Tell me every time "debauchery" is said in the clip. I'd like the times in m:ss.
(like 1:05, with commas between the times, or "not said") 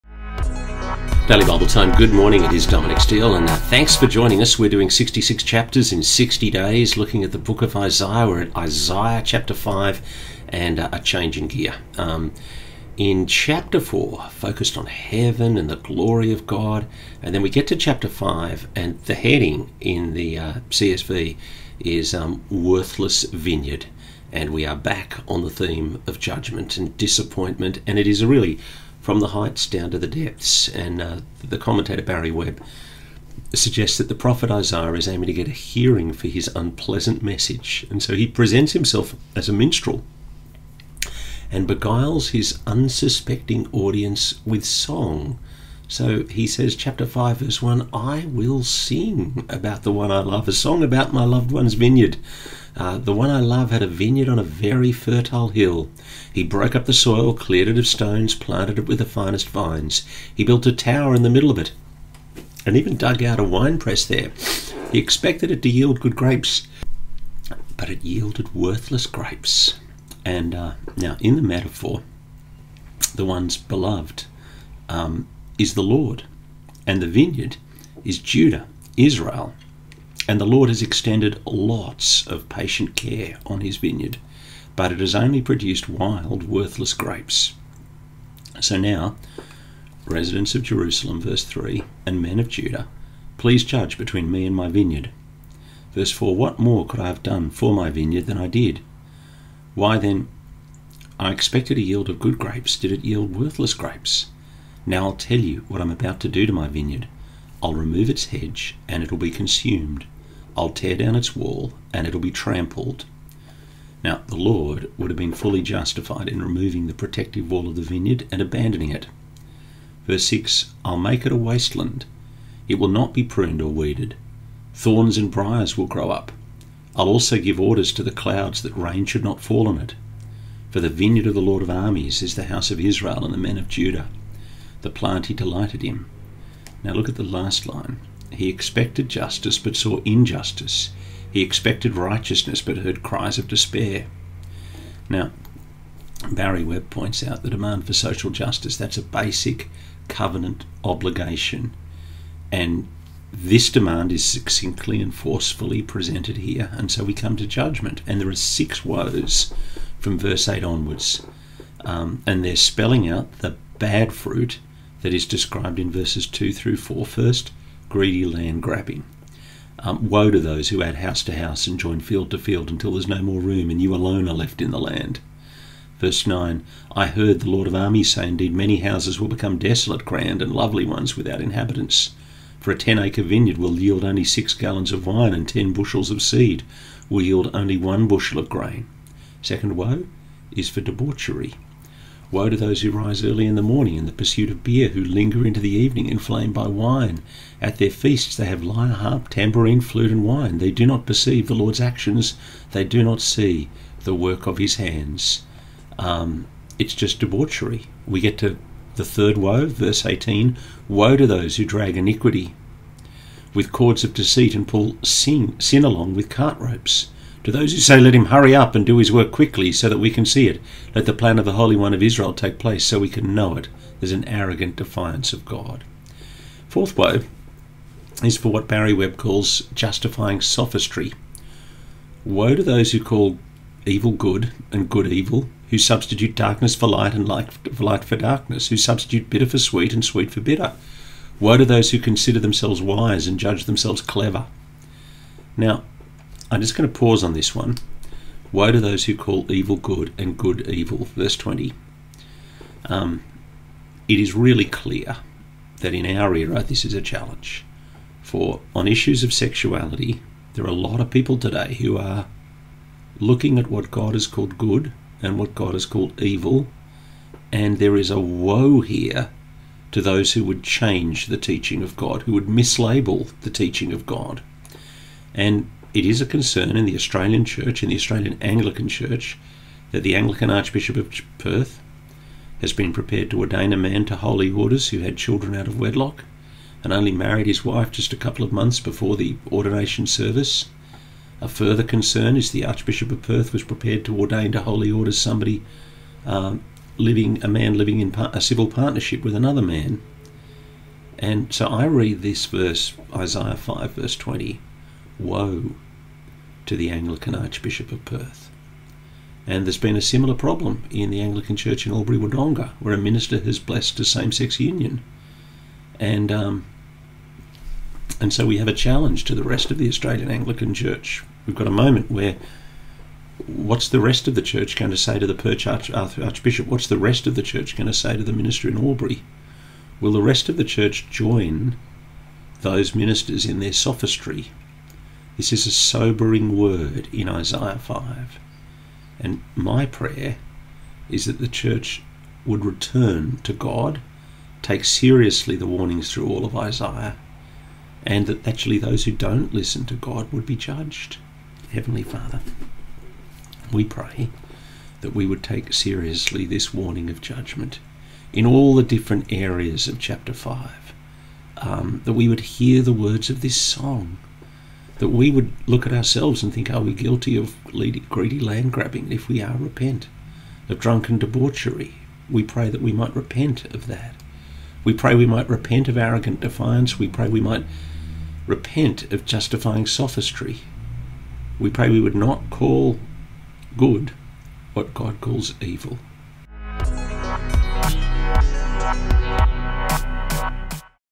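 3:10, 3:27, 6:11.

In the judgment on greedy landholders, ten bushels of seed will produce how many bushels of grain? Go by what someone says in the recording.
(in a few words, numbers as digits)
1 bushel.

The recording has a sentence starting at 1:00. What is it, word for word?
He built a tower in the middle of it, and even dug out a wine press there.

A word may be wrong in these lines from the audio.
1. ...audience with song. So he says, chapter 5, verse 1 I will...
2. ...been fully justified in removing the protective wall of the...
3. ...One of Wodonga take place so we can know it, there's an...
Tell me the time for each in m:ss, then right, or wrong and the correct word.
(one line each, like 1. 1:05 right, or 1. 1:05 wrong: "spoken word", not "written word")
1. 0:43 right
2. 1:55 right
3. 3:41 wrong: "Israel", not "Wodonga".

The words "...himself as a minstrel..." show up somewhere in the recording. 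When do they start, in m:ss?
0:38.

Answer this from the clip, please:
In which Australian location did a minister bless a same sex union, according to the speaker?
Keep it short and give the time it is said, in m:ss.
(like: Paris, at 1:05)
Albury Wodonga, at 5:11.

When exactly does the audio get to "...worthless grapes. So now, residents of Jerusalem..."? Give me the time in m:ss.
1:26.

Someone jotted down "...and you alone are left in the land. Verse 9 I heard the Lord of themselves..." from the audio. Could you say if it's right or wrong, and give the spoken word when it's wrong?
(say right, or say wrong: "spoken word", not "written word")
wrong: "armies", not "themselves".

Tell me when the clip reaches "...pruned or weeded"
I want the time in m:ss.
2:03.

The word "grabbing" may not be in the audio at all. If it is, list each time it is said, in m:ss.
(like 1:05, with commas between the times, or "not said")
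2:48, 6:08.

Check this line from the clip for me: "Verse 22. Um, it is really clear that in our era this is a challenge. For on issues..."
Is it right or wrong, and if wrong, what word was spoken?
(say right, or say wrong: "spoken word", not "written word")
wrong: "20", not "22".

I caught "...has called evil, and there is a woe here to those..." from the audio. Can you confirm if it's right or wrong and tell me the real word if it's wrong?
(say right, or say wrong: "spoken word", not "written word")
right.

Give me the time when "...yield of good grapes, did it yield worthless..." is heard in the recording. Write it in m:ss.
1:41.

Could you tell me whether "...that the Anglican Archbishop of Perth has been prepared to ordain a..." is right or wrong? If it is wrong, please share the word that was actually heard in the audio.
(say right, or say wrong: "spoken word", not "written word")
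right.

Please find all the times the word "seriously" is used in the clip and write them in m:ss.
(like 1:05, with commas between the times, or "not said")
5:44, 5:55.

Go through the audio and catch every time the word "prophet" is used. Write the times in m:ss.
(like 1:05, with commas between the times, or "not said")
0:34.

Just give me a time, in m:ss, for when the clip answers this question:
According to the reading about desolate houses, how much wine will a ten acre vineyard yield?
3:04.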